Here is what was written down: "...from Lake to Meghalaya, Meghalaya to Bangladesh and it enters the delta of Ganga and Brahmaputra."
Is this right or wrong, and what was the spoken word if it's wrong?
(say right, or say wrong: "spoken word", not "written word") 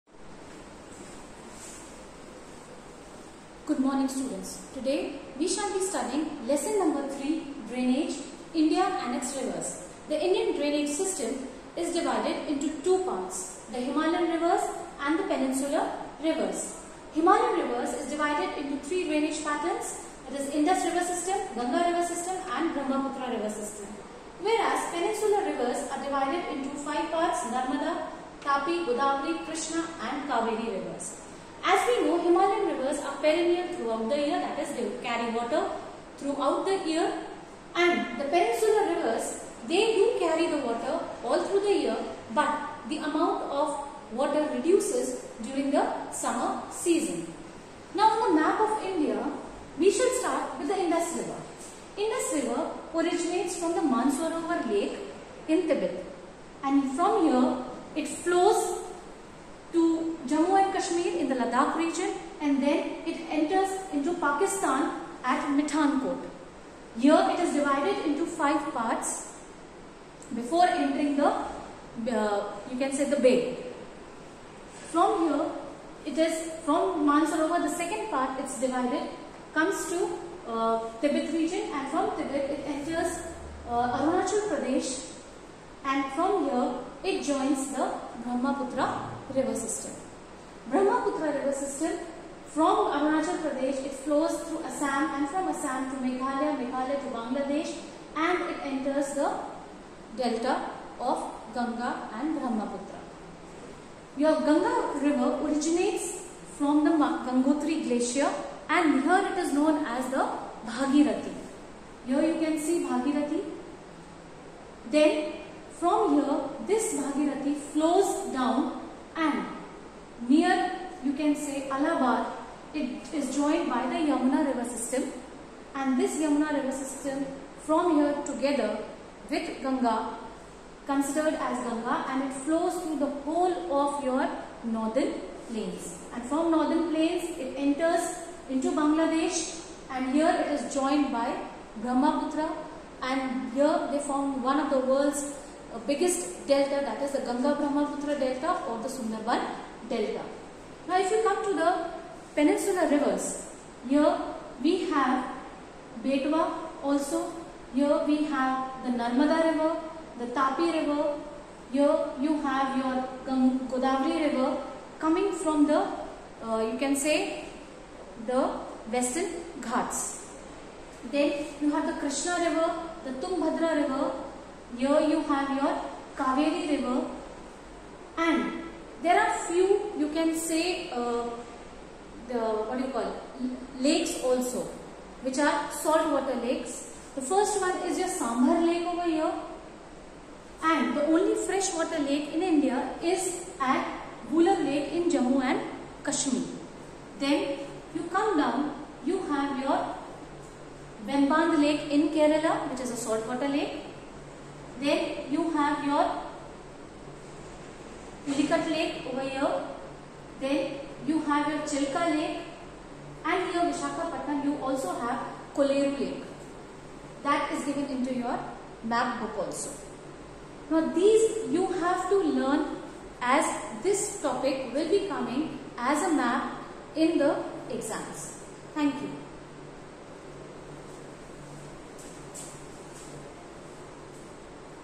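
wrong: "Assam", not "Lake".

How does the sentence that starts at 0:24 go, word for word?
Whereas peninsular rivers are divided into five parts Narmada, Tapi, Godavari, Krishna and Kaveri rivers.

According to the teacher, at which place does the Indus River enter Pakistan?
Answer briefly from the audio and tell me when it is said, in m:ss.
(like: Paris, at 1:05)
Mithankot, at 1:05.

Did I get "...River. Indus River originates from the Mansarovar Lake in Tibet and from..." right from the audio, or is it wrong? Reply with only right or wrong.
right.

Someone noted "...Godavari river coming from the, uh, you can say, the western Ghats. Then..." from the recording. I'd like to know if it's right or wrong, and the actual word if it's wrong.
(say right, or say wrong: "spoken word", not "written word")
right.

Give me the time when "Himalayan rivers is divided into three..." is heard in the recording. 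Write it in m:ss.
0:17.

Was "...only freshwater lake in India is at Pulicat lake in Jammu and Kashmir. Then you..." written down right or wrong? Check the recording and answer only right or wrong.
wrong.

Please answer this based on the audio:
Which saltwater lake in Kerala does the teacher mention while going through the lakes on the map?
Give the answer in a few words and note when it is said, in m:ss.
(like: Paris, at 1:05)
Vemband lake, at 3:21.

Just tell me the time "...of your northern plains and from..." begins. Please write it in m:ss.
2:13.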